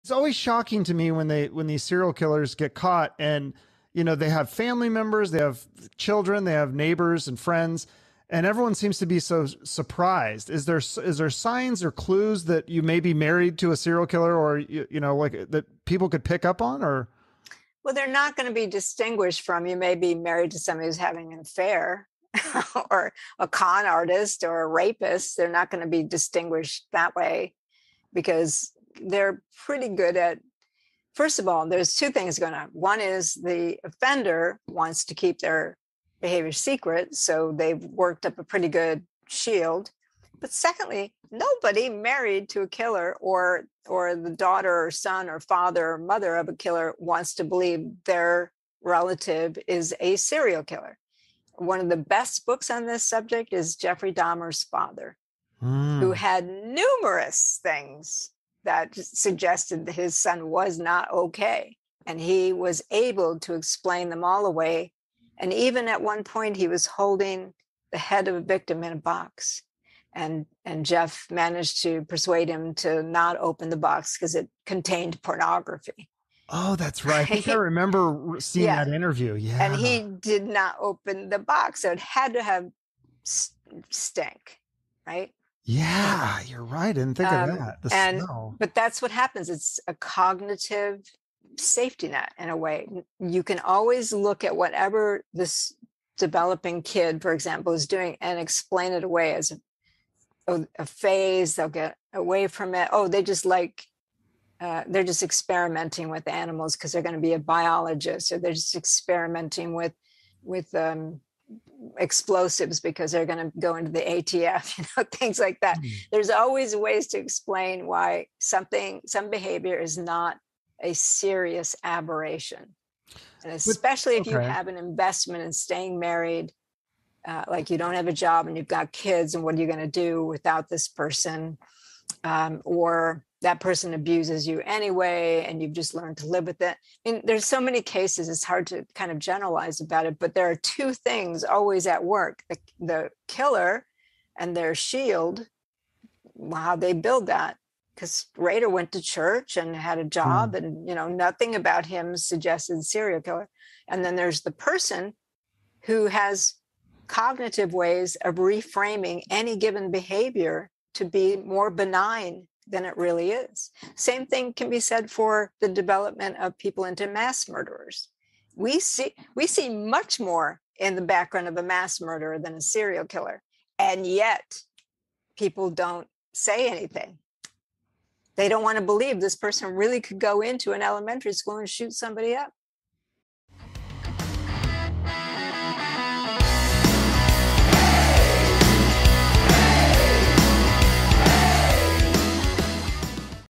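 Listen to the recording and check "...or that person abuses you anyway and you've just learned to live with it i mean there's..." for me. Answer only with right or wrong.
right.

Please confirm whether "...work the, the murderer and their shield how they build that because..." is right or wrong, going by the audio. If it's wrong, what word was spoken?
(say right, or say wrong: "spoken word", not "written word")
wrong: "killer", not "murderer".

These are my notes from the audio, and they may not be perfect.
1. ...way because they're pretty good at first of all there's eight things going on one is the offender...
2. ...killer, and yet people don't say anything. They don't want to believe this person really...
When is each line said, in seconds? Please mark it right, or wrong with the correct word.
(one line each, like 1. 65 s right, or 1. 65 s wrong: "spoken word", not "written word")
1. 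27 s wrong: "two", not "eight"
2. 173 s right.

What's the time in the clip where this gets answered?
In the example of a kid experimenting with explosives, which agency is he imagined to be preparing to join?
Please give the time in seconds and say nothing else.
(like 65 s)
114 s.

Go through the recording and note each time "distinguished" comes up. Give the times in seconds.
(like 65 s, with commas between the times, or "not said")
18 s, 26 s.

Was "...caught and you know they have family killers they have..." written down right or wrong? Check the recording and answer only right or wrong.
wrong.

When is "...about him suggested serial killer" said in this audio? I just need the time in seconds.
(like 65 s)
151 s.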